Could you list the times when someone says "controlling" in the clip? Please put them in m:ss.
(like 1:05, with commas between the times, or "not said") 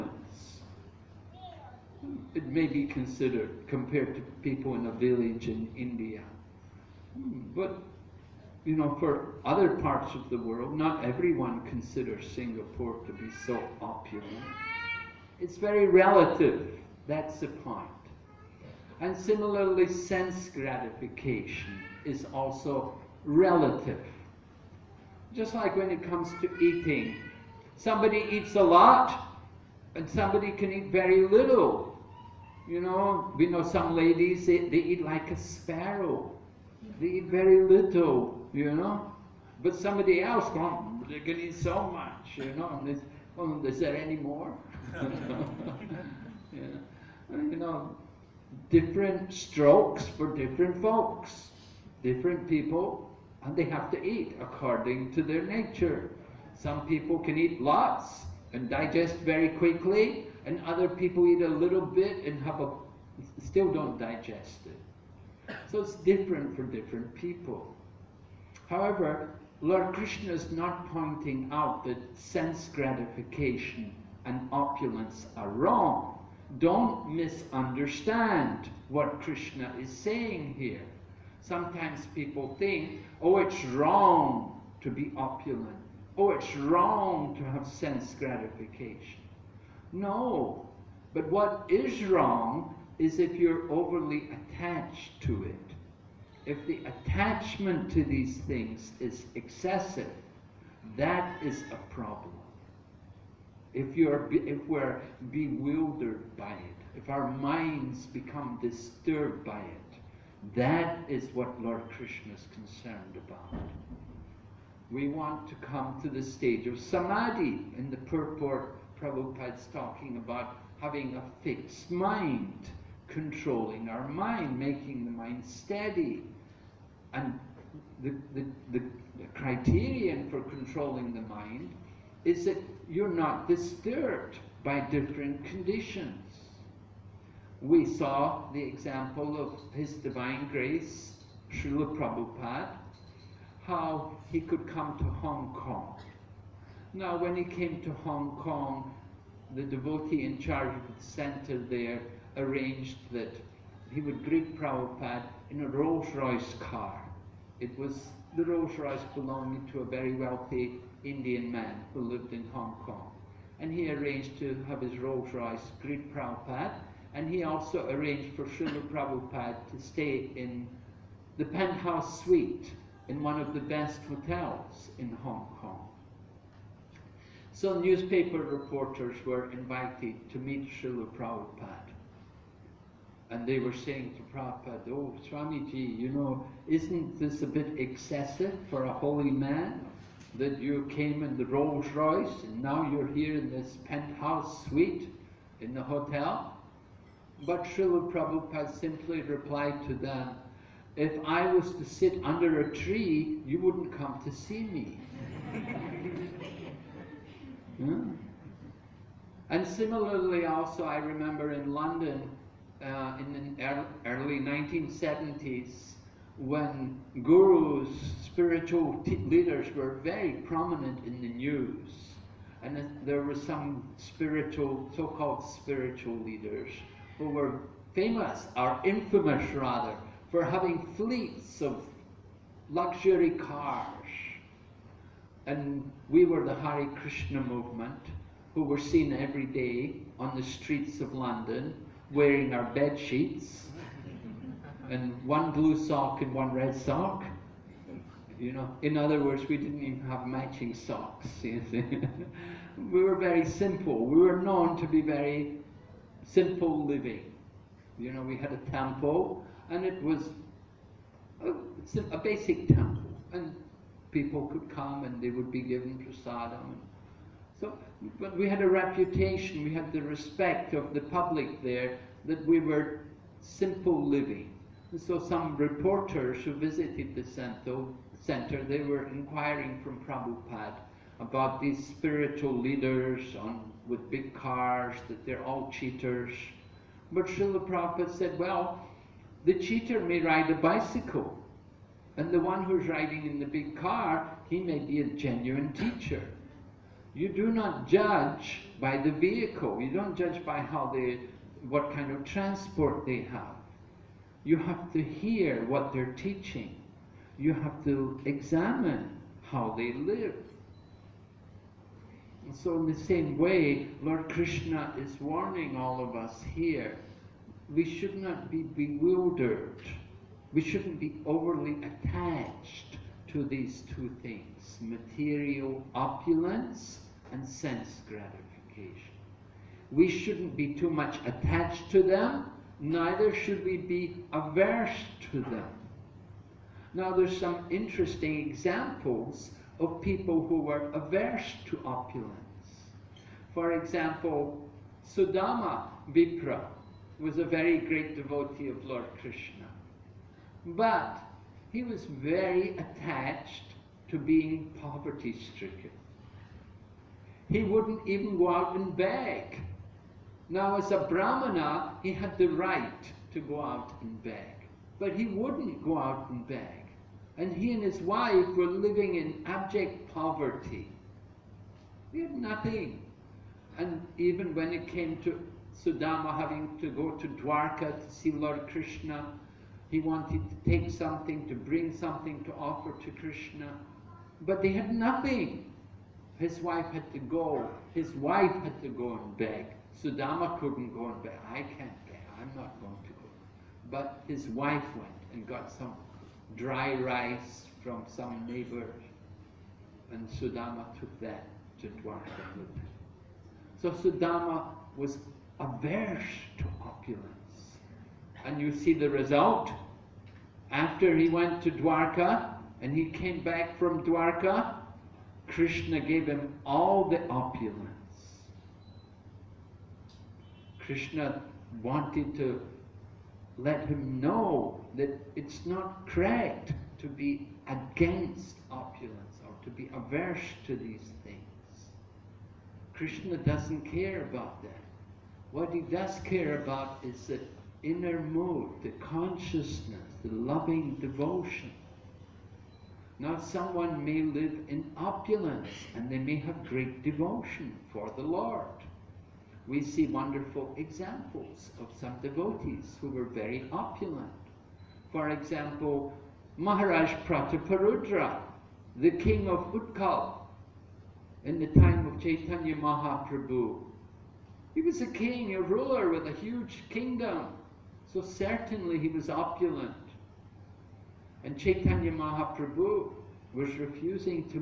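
2:03, 2:10.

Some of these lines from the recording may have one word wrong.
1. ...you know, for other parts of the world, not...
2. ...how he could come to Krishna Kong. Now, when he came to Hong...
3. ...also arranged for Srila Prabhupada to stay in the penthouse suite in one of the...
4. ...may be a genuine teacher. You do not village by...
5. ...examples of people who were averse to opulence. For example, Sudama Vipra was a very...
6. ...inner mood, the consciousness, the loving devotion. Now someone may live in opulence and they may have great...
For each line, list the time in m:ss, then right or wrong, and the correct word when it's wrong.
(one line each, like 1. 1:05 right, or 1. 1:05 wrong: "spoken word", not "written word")
1. 0:08 right
2. 2:23 wrong: "Hong", not "Krishna"
3. 2:47 right
4. 4:54 wrong: "judge", not "village"
5. 5:38 right
6. 7:17 right.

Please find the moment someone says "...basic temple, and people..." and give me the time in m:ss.
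4:22.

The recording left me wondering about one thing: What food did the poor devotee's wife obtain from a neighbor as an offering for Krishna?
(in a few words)
dry rice.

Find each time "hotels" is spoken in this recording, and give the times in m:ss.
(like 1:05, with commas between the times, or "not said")
2:54, 3:15.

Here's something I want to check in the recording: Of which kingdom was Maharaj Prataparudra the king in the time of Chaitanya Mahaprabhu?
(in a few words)
Utkal.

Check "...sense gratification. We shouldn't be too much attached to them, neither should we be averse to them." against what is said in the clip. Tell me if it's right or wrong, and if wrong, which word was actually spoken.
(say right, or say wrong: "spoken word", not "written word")
right.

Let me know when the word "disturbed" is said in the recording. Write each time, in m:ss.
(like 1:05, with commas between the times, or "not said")
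1:48, 2:13.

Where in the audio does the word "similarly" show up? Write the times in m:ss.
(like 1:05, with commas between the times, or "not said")
0:19, 3:29.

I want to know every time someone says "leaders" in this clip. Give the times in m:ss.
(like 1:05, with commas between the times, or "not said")
3:39, 3:46, 4:42.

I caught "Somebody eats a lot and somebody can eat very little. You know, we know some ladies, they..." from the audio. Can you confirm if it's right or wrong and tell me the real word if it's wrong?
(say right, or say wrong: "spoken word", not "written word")
right.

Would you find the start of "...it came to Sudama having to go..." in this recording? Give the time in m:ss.
6:14.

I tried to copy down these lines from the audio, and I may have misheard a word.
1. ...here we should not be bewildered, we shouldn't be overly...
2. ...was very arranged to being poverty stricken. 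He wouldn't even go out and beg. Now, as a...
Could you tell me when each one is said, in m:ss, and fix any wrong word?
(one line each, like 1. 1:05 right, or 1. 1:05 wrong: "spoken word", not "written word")
1. 5:16 right
2. 5:51 wrong: "attached", not "arranged".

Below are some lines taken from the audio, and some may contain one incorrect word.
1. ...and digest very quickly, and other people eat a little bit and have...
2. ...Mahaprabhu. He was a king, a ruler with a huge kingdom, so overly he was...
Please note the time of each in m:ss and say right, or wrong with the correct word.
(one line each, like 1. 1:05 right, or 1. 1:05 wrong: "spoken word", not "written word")
1. 0:58 right
2. 7:42 wrong: "certainly", not "overly".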